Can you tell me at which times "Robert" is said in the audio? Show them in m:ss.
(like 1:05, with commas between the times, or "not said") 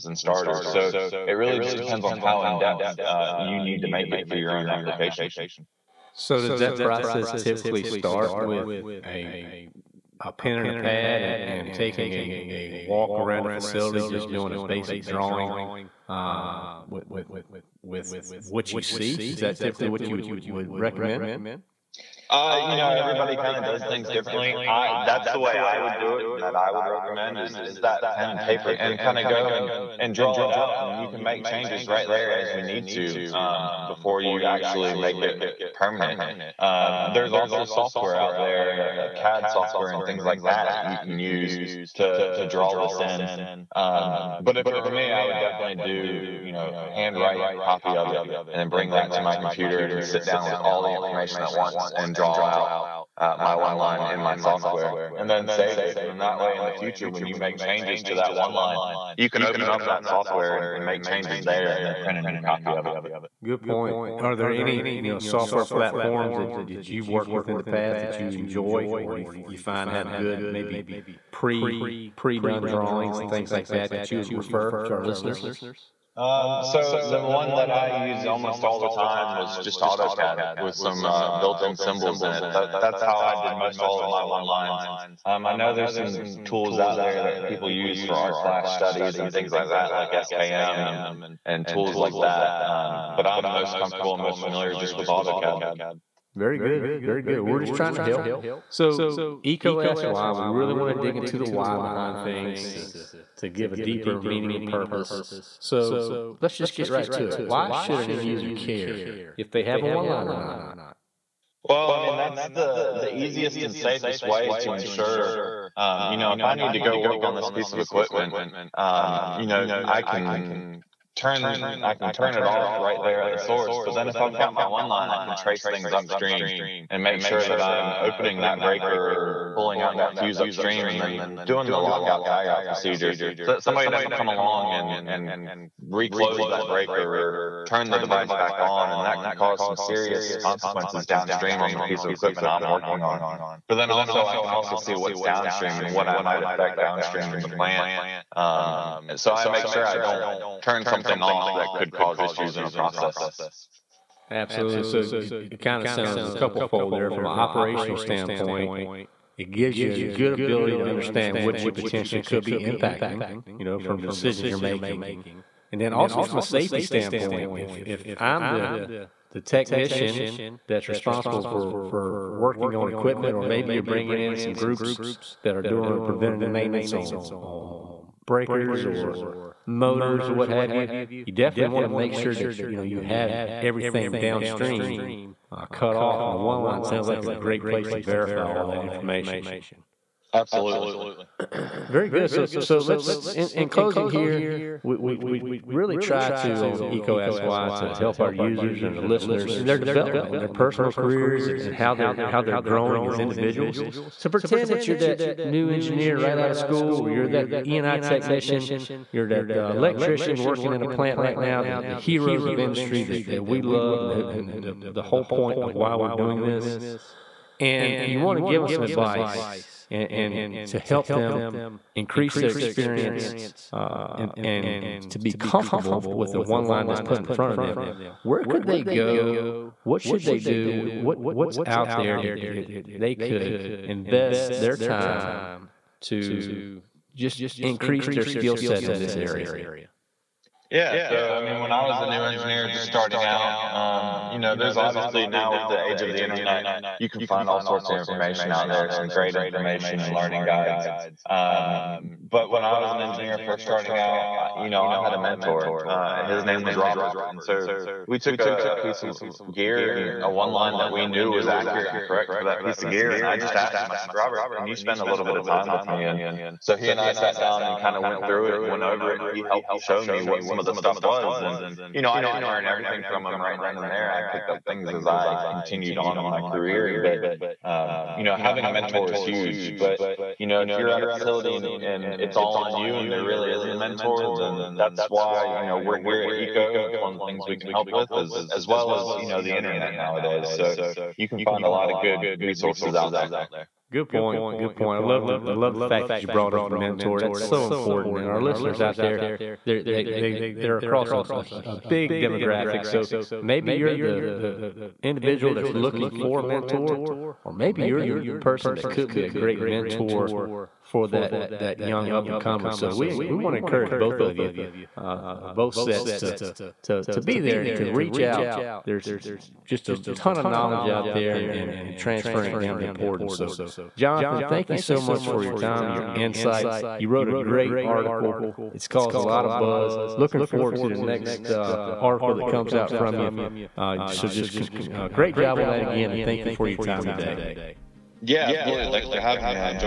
4:16, 4:24.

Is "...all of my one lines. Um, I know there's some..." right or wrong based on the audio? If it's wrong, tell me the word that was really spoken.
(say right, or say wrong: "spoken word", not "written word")
right.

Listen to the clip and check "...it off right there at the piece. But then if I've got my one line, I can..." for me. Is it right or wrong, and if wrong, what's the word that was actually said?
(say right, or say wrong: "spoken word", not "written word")
wrong: "source", not "piece".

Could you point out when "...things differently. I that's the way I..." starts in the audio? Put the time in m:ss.
0:23.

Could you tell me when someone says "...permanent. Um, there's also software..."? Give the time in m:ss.
0:35.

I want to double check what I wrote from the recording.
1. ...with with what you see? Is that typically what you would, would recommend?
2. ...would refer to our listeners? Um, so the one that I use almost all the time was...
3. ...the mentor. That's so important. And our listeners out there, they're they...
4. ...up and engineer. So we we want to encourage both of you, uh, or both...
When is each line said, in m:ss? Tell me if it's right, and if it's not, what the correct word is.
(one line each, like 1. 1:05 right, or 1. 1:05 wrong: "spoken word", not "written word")
1. 0:17 right
2. 1:14 right
3. 4:56 right
4. 5:12 wrong: "comer", not "engineer".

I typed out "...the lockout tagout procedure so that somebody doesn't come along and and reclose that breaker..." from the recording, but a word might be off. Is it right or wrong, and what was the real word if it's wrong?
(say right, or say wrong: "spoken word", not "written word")
right.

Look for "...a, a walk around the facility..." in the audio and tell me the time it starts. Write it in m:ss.
0:12.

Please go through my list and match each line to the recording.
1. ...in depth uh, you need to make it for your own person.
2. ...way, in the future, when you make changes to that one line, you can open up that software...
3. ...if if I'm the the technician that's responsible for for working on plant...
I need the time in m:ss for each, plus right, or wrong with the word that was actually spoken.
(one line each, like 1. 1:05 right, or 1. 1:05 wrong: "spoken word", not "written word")
1. 0:02 wrong: "application", not "person"
2. 0:56 right
3. 2:47 wrong: "equipment", not "plant".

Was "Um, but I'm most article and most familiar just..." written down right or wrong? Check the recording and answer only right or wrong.
wrong.